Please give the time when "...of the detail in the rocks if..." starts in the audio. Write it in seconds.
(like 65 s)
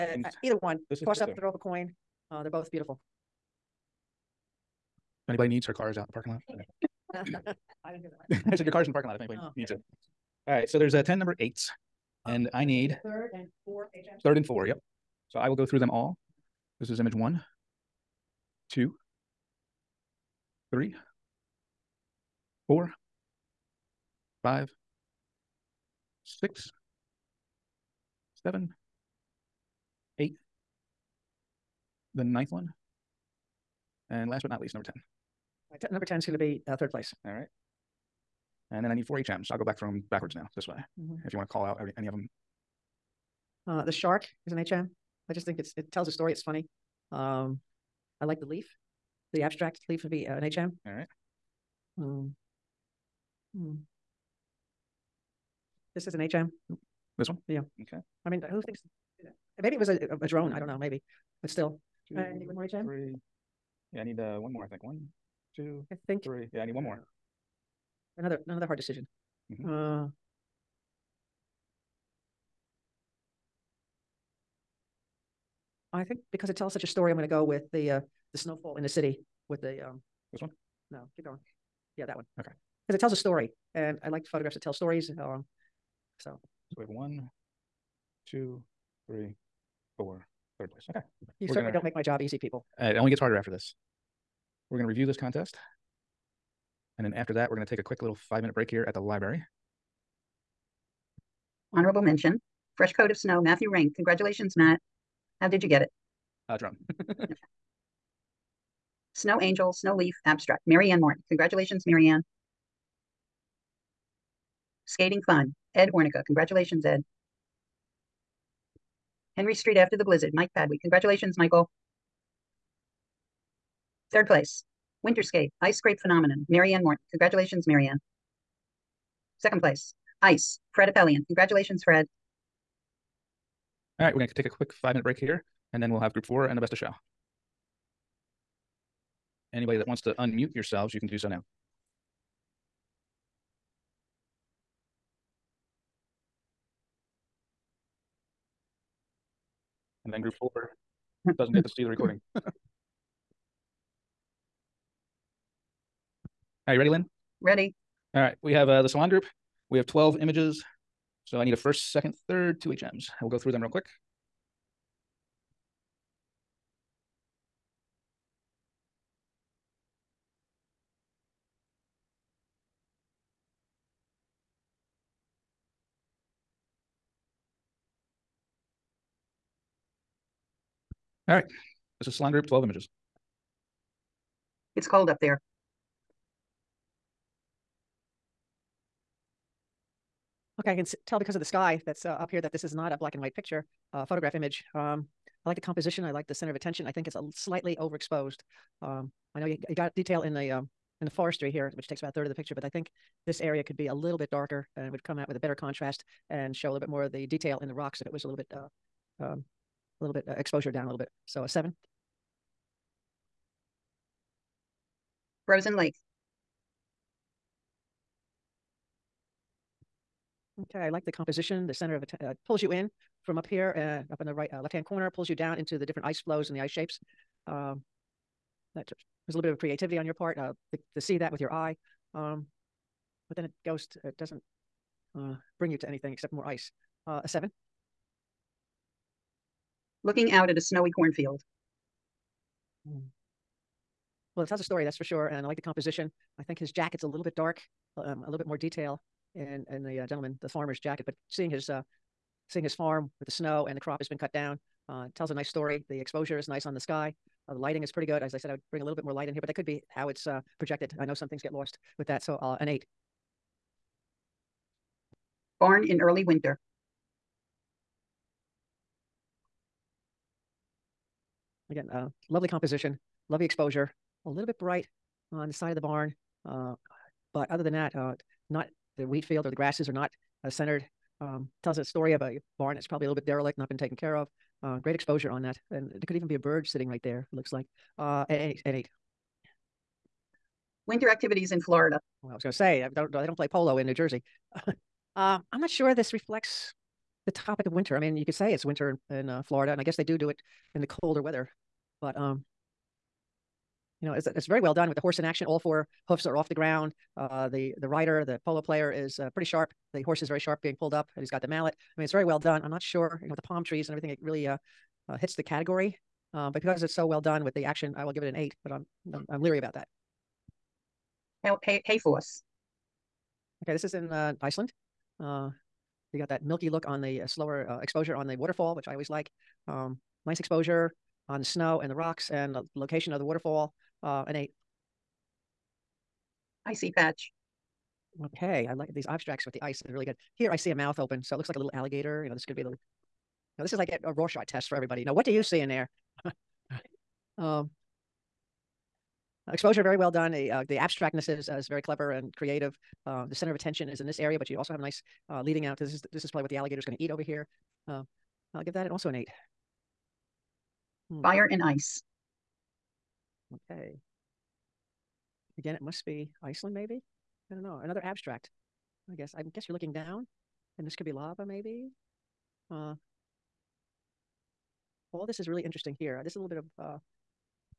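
207 s.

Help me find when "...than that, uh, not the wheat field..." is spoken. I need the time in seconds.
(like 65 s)
277 s.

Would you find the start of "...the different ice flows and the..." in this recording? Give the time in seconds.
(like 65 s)
225 s.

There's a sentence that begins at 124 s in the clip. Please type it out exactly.
Third place, Winterscape, Ice Crepe Phenomenon, Marianne Morton.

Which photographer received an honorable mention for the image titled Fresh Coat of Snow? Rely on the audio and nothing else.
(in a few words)
Matthew Rank.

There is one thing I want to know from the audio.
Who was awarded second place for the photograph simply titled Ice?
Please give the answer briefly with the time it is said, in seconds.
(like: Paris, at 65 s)
Fred Appelian, at 130 s.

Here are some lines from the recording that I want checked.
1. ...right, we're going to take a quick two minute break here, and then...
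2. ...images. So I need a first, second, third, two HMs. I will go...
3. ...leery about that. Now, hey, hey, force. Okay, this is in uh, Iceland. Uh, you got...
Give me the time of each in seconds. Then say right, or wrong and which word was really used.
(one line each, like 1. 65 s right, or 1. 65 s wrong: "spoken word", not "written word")
1. 134 s wrong: "five", not "two"
2. 160 s right
3. 319 s right.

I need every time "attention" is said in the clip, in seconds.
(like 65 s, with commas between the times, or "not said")
196 s, 353 s.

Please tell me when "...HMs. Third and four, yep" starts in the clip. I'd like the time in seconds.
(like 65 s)
13 s.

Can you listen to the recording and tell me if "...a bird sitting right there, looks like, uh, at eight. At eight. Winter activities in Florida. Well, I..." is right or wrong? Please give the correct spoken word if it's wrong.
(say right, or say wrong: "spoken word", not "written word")
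right.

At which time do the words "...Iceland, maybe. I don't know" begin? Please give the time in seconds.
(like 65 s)
366 s.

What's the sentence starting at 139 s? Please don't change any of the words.
Anybody that wants to unmute yourselves, you can do so now.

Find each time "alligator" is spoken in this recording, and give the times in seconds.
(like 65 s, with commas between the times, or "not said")
341 s, 356 s.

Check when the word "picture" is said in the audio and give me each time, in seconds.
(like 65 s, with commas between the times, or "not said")
193 s, 202 s.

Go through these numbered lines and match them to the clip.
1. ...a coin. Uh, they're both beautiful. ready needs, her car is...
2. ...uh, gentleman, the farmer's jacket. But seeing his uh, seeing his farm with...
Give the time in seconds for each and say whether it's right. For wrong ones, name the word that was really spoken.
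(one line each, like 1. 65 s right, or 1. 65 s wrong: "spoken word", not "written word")
1. 1 s wrong: "anybody", not "ready"
2. 250 s right.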